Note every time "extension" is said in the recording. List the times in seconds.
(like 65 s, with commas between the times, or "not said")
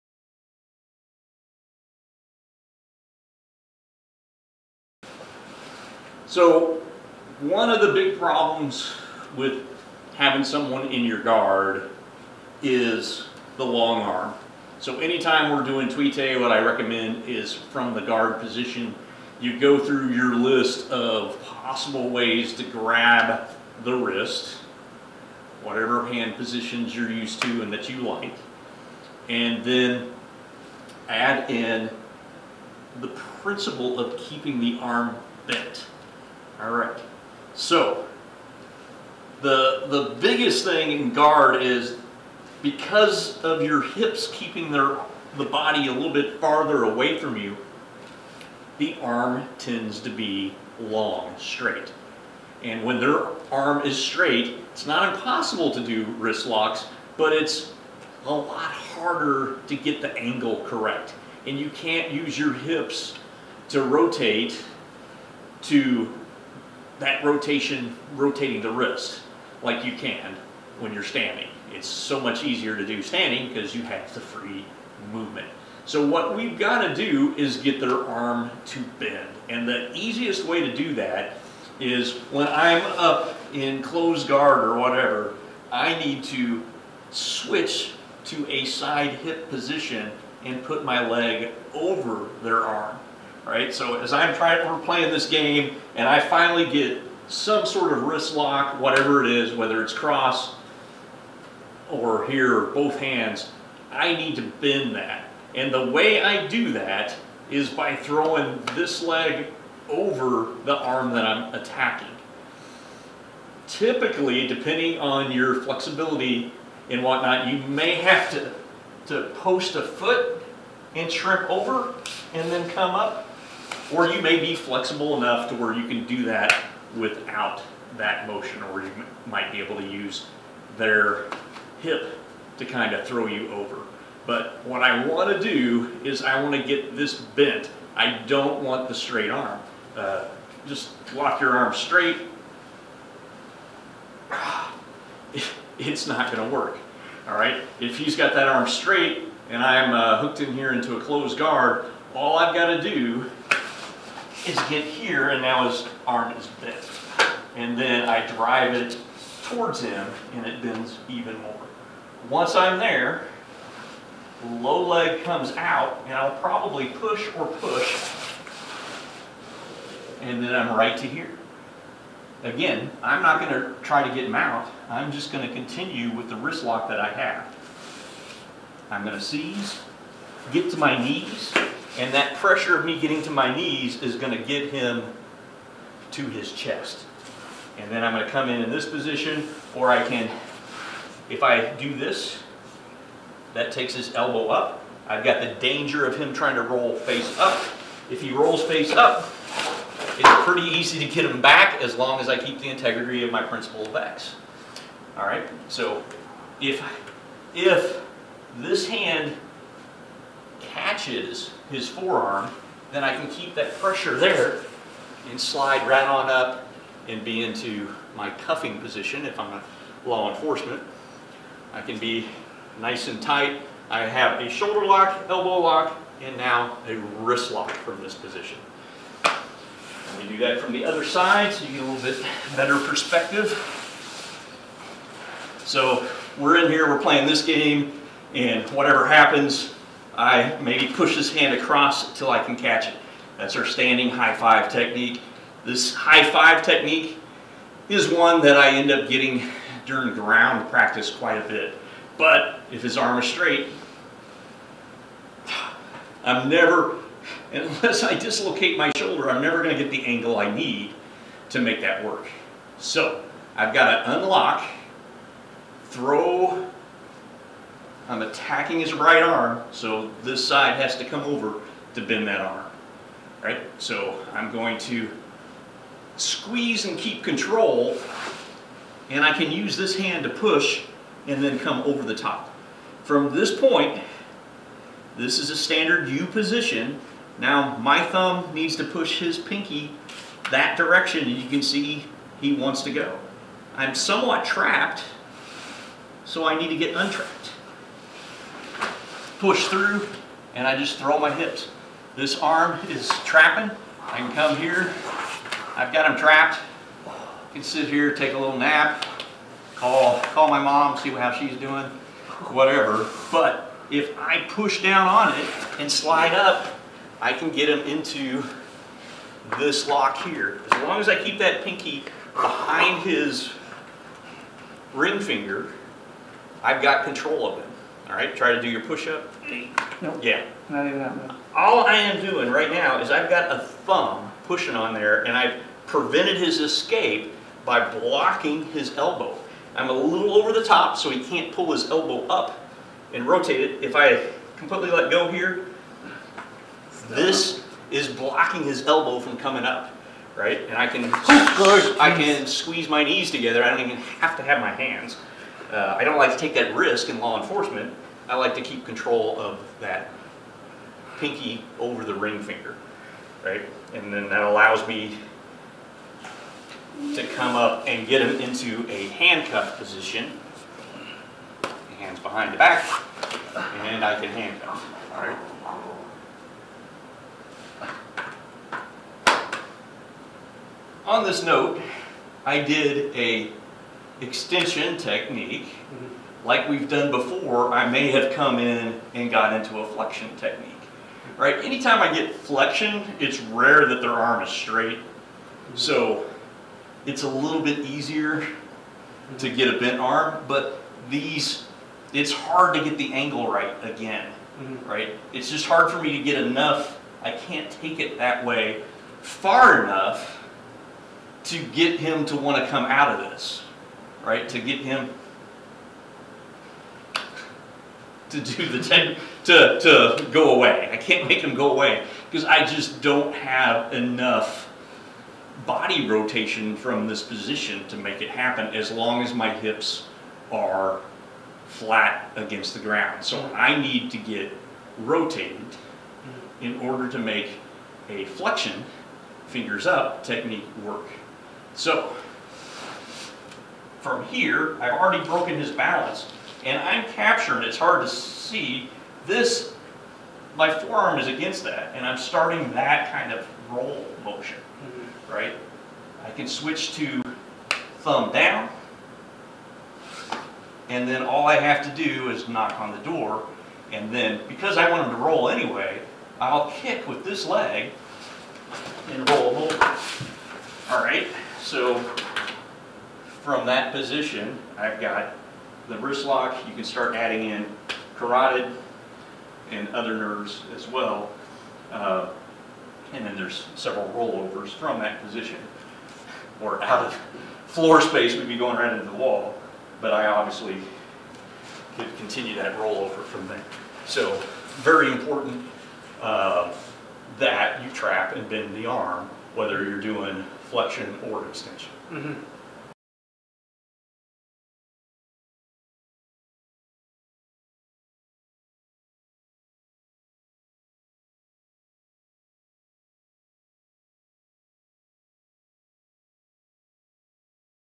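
384 s, 501 s.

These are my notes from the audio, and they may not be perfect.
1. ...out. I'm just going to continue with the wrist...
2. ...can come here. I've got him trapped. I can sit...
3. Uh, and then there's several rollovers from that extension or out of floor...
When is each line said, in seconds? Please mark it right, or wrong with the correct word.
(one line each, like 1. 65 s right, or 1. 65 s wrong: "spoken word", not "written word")
1. 174 s right
2. 304 s right
3. 481 s wrong: "position", not "extension".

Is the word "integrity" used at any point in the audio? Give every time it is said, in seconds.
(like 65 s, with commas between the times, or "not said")
202 s.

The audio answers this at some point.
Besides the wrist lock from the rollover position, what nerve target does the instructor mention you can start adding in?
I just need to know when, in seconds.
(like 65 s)
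478 s.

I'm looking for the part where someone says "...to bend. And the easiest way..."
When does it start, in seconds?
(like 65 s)
78 s.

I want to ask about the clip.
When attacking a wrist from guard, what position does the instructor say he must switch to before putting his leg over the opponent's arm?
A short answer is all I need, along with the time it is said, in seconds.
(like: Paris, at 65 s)
side hip position, at 88 s.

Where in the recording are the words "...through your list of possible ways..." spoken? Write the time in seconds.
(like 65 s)
19 s.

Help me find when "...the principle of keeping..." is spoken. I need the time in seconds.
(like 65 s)
33 s.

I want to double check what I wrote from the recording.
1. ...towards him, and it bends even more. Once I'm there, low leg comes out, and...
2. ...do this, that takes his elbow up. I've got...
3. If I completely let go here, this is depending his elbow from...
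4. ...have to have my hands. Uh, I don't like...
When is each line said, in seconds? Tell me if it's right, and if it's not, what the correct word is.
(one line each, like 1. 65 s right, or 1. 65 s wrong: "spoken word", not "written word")
1. 159 s right
2. 191 s right
3. 343 s wrong: "blocking", not "depending"
4. 354 s right.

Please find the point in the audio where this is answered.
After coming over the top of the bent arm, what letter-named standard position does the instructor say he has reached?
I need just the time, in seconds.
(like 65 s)
285 s.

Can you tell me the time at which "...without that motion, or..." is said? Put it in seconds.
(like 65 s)
126 s.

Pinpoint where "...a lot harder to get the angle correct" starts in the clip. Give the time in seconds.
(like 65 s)
58 s.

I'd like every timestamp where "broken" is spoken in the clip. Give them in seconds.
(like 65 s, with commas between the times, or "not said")
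445 s.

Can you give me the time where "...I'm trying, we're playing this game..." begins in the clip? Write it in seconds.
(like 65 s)
94 s.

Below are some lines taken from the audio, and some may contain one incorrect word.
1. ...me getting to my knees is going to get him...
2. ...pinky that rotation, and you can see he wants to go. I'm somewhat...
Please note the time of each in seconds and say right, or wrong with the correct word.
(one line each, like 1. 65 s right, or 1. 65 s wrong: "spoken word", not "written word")
1. 182 s right
2. 289 s wrong: "direction", not "rotation".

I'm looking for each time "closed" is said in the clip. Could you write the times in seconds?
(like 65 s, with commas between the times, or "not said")
83 s, 151 s.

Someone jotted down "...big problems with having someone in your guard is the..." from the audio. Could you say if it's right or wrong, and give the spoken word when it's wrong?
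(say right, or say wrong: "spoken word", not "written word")
right.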